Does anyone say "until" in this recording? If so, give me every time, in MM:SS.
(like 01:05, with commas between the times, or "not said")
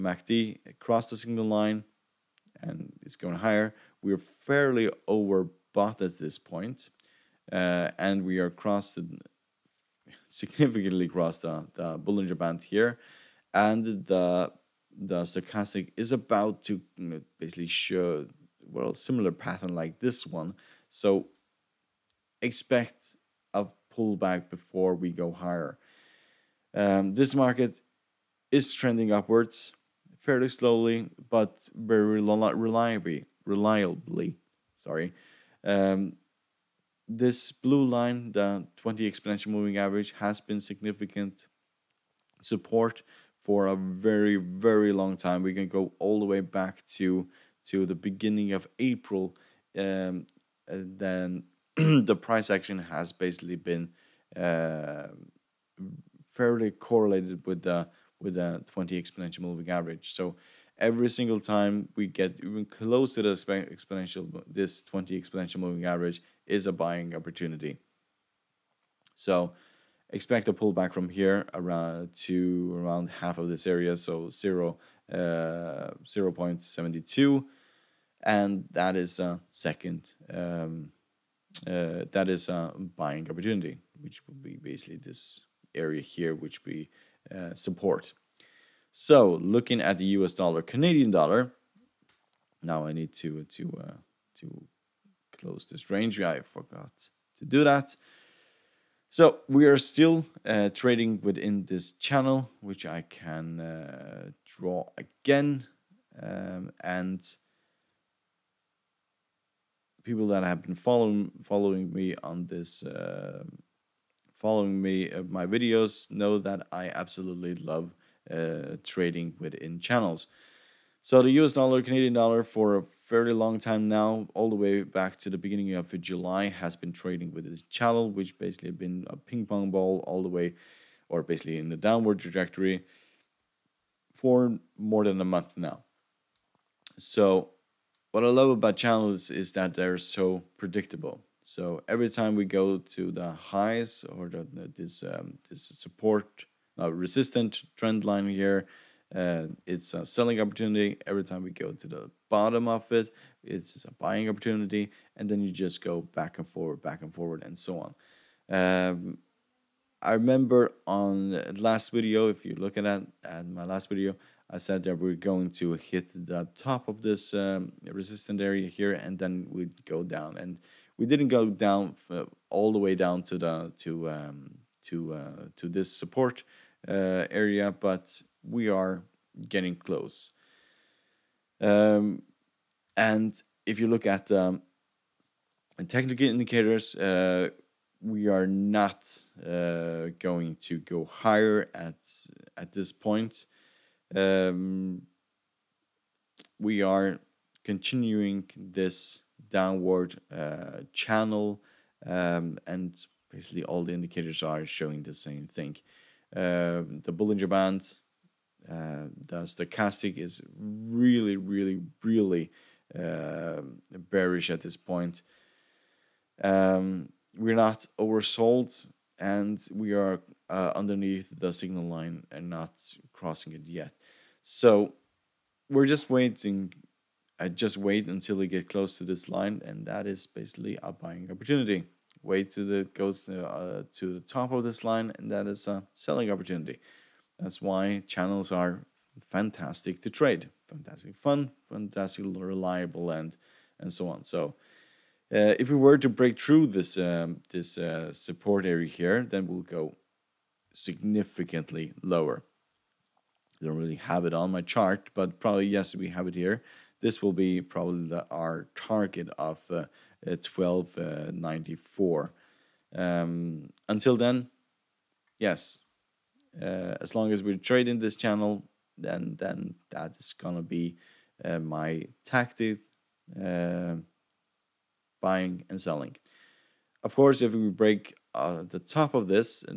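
03:48, 04:23.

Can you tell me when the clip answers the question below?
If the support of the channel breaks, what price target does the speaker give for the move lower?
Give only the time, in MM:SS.
04:20.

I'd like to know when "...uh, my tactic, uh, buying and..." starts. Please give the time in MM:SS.
04:31.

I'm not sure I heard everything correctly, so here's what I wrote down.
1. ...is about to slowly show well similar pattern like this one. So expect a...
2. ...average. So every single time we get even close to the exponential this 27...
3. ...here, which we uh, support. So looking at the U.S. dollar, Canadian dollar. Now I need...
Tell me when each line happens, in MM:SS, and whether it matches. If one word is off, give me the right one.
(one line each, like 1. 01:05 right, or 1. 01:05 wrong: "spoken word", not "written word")
1. 00:15 wrong: "basically", not "slowly"
2. 00:59 wrong: "20", not "27"
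3. 01:26 right.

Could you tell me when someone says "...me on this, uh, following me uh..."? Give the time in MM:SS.
01:51.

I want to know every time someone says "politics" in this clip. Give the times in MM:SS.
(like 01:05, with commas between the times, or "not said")
not said.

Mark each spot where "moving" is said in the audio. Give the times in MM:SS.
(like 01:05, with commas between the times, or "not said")
00:39, 00:59, 01:05.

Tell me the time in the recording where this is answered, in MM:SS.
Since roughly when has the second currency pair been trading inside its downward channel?
02:05.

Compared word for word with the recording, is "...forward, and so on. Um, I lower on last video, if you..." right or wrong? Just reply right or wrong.
wrong.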